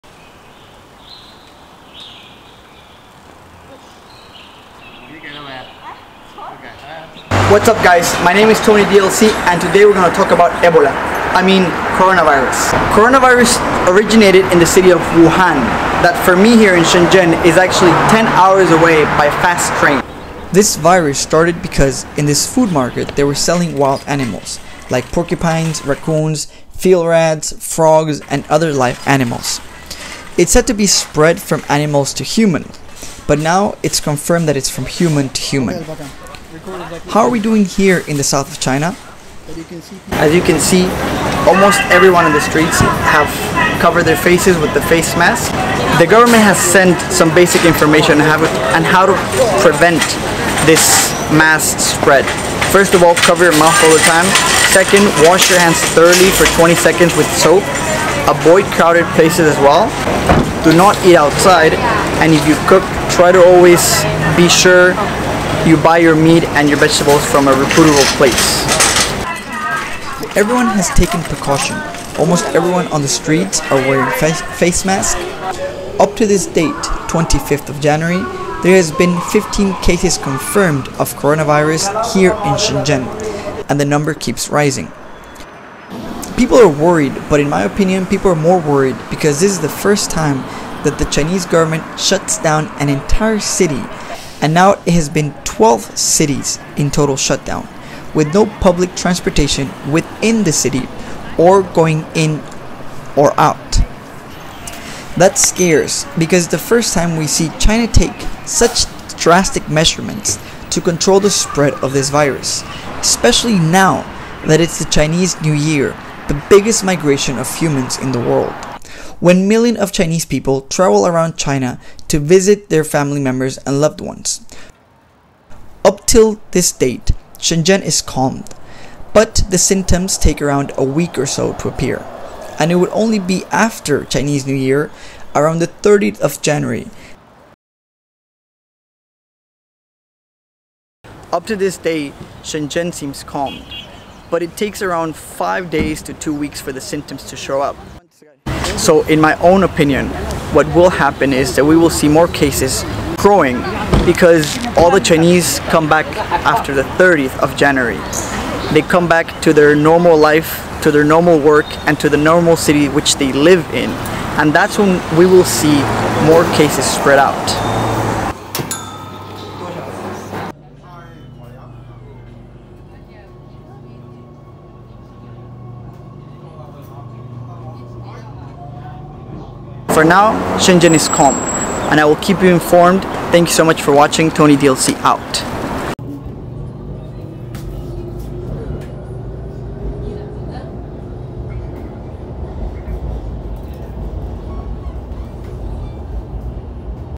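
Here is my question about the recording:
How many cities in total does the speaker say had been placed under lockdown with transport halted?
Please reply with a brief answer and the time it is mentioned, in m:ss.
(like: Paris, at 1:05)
12, at 1:35.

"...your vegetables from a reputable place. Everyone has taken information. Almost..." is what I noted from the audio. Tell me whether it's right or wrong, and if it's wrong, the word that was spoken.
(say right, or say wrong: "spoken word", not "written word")
wrong: "precaution", not "information".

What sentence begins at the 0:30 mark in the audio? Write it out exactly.
It's said to be spread from animals to humans but now it's confirmed that it's from human to human.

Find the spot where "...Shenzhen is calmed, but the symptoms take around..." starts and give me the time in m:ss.
2:07.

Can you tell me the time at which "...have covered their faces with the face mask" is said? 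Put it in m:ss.
0:43.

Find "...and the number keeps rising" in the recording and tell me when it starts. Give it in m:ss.
1:23.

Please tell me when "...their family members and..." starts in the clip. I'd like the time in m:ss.
2:02.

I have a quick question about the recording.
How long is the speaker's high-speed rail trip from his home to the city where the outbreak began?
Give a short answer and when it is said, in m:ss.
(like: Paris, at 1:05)
10 hours, at 0:18.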